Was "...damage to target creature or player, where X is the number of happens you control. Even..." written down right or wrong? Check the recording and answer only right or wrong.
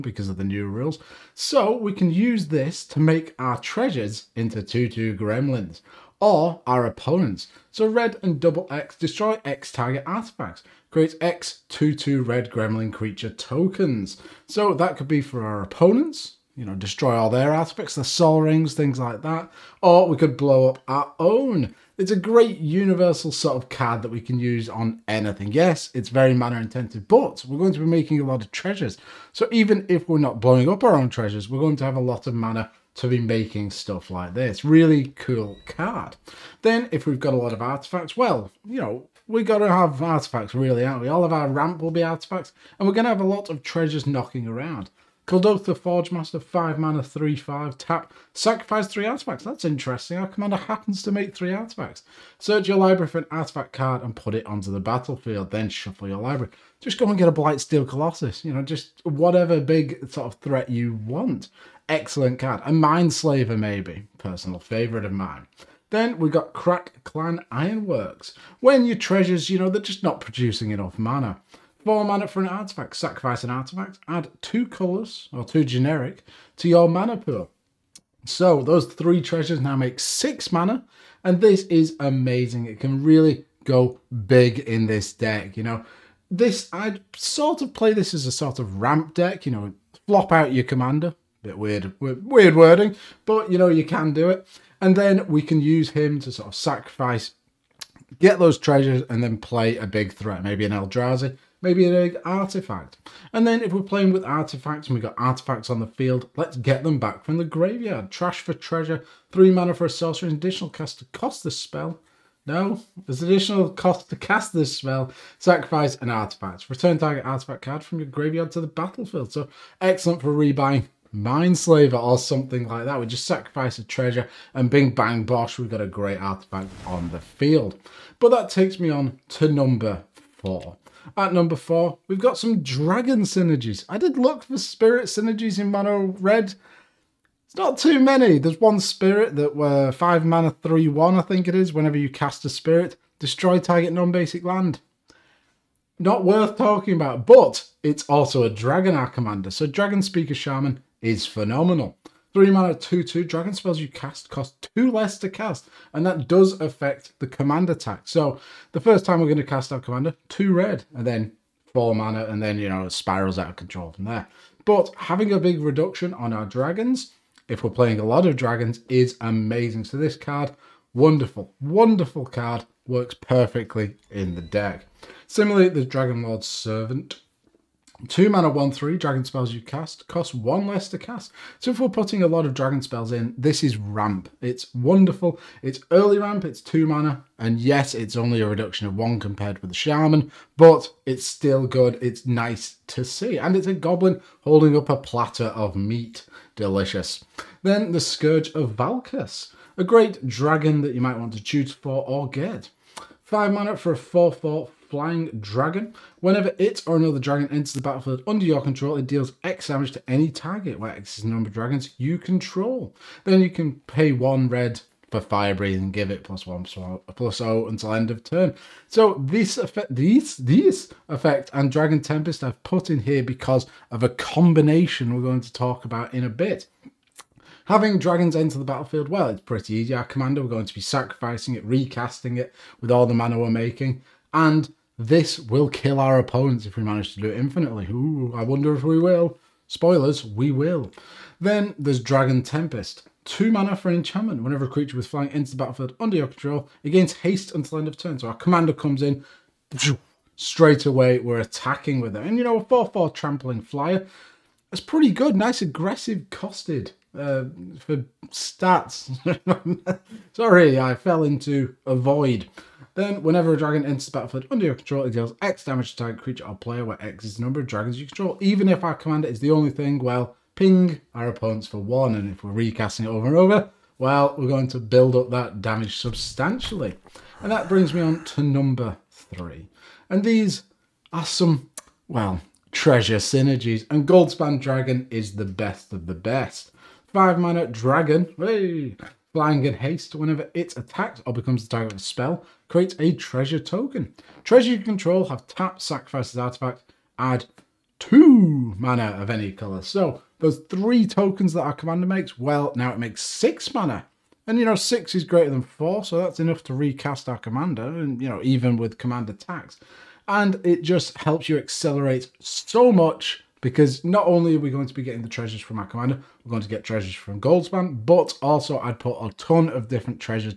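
wrong.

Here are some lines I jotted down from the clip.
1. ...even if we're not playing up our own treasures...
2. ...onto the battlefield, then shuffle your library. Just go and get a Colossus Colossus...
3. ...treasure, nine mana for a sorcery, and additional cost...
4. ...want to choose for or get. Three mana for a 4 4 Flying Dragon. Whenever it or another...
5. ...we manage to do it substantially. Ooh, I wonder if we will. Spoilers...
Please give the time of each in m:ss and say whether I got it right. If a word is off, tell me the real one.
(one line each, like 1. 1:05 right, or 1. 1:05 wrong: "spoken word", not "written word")
1. 0:29 wrong: "blowing", not "playing"
2. 0:54 wrong: "Blightsteel", not "Colossus"
3. 1:48 wrong: "three", not "nine"
4. 3:21 wrong: "Five", not "Three"
5. 3:56 wrong: "infinitely", not "substantially".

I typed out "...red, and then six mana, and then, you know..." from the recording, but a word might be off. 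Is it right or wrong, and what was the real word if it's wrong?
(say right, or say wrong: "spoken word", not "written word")
wrong: "four", not "six".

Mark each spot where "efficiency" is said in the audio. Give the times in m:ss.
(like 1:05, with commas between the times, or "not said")
not said.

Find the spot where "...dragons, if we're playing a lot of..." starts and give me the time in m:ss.
2:46.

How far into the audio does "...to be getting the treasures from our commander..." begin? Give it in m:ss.
5:14.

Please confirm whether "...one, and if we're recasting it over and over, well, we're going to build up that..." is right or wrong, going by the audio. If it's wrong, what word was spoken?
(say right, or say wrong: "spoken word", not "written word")
right.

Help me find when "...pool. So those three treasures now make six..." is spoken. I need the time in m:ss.
1:17.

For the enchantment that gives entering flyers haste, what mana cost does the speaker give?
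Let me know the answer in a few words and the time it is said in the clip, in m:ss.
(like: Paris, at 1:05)
2, at 4:03.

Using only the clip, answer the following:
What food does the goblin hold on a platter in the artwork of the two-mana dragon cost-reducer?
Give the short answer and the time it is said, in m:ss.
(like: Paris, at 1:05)
Meat, at 3:14.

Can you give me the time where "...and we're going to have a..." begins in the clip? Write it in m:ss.
0:42.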